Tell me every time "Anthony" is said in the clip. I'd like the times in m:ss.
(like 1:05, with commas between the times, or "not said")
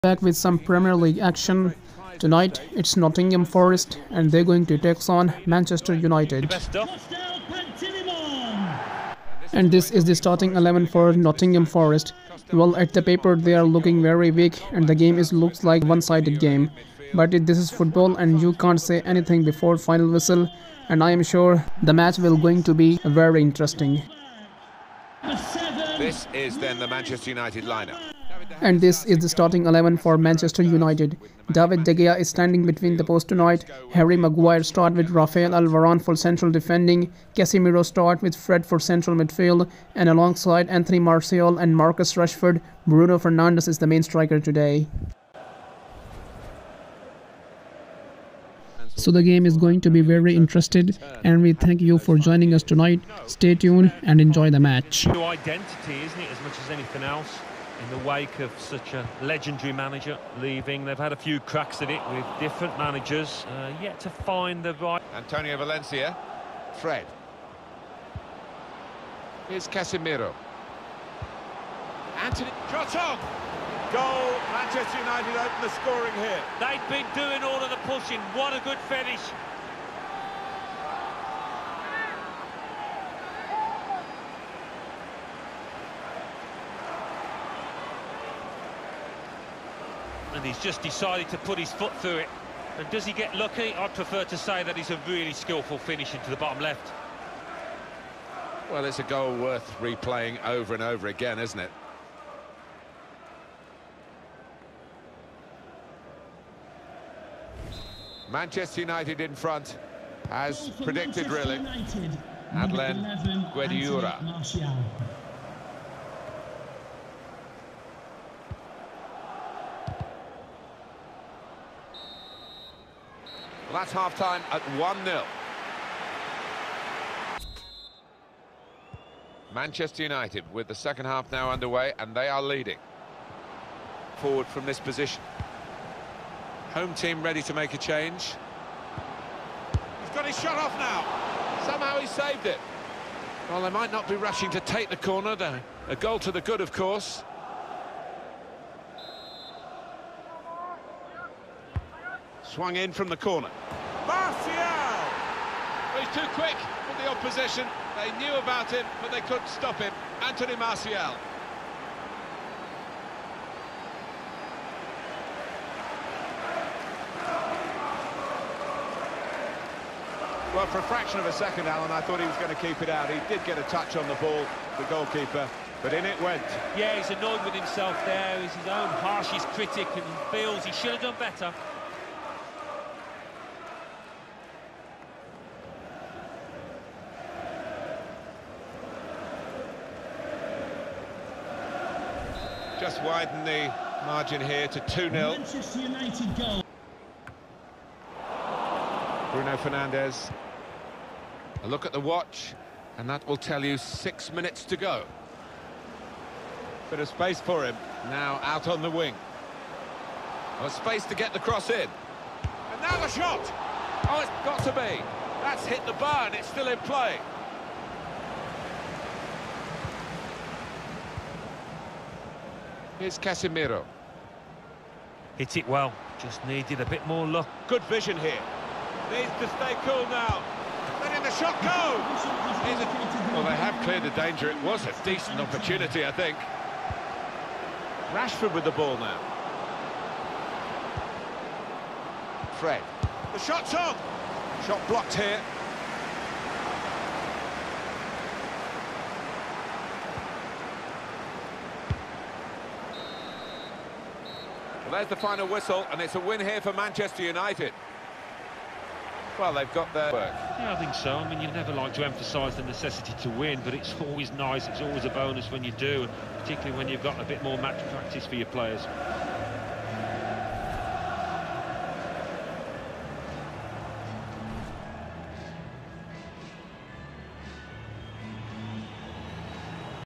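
0:40, 1:12, 2:40.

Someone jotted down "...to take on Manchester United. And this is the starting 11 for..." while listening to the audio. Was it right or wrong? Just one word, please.
right.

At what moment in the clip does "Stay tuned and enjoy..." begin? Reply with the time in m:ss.
0:53.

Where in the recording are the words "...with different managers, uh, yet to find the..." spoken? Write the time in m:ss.
1:02.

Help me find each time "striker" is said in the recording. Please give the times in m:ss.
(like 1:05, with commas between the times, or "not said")
0:44.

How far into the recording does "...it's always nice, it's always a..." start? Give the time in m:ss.
4:23.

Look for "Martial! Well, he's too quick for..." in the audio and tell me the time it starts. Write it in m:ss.
2:34.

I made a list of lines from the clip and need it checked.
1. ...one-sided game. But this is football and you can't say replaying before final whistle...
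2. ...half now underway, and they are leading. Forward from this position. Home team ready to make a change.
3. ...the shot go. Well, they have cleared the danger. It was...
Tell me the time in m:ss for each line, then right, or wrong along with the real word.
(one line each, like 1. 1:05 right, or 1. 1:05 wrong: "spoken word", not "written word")
1. 0:15 wrong: "anything", not "replaying"
2. 2:11 right
3. 3:51 right.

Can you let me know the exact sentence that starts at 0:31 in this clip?
David De Gea is standing between the posts tonight.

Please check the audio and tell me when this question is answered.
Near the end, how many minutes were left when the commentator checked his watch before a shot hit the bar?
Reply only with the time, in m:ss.
3:23.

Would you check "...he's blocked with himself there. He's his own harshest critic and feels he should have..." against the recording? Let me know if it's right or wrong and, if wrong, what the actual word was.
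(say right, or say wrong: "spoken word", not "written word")
wrong: "annoyed", not "blocked".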